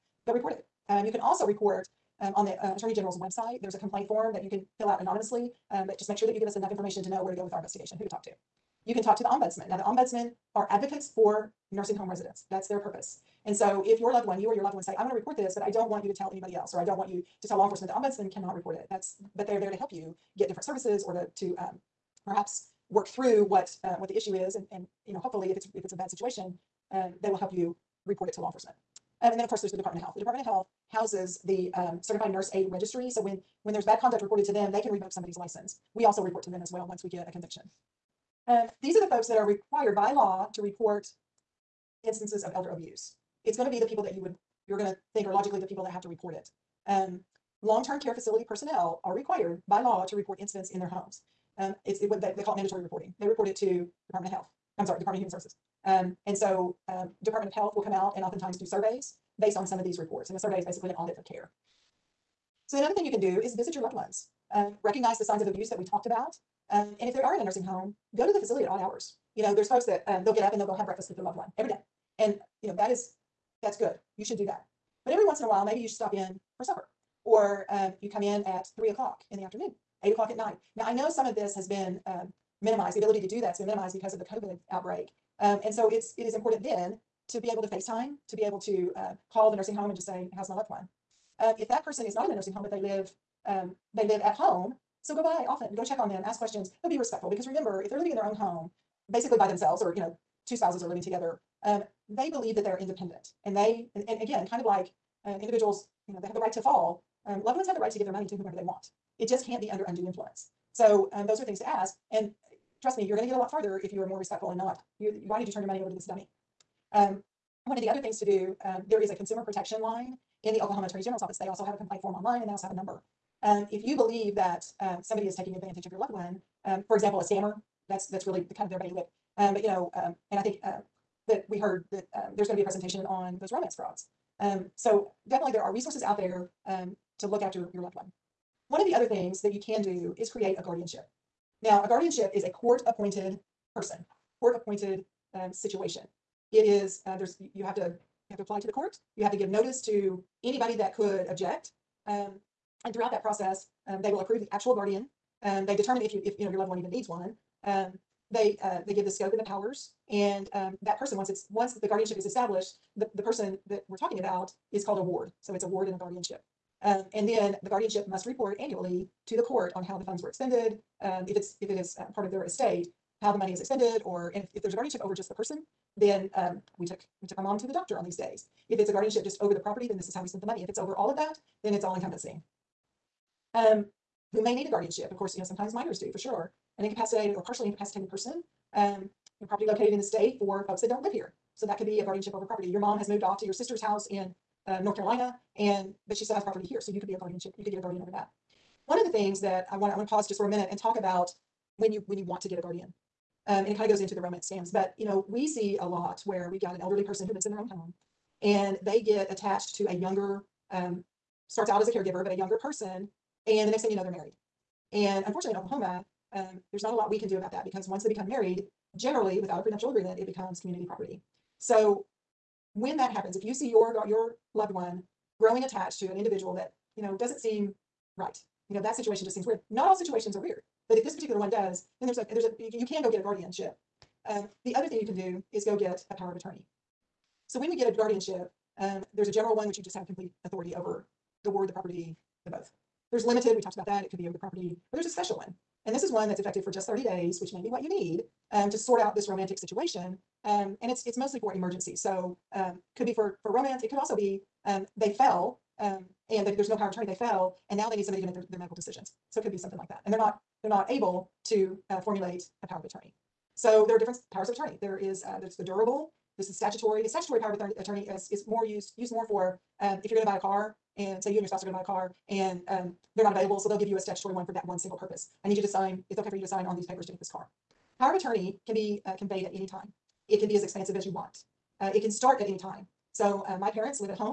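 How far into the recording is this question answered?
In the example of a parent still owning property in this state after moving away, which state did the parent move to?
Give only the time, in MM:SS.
03:14.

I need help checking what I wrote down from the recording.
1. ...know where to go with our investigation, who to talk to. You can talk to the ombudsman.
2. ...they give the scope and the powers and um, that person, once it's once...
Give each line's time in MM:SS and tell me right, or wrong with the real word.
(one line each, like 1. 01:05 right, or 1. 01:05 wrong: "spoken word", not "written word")
1. 00:07 right
2. 02:38 right.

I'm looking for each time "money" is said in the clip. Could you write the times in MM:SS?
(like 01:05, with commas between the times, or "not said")
01:48, 01:55, 02:53, 03:00.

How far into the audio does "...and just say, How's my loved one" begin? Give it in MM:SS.
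01:29.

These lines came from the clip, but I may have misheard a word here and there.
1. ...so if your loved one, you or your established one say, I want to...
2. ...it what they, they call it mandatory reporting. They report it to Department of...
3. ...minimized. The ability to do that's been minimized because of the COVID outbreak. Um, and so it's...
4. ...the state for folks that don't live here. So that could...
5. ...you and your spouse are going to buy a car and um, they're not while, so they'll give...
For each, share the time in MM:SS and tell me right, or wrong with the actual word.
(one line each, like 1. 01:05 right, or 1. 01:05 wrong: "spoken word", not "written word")
1. 00:13 wrong: "loved", not "established"
2. 00:51 right
3. 01:22 right
4. 03:09 right
5. 04:31 wrong: "available", not "while".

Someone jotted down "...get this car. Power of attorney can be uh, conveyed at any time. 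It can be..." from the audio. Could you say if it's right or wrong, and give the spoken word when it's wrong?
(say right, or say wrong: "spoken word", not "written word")
right.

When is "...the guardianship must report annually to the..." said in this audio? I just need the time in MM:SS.
02:47.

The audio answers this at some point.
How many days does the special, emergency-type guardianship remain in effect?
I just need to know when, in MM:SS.
04:06.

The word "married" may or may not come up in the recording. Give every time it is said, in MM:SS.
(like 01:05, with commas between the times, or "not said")
03:34, 03:38.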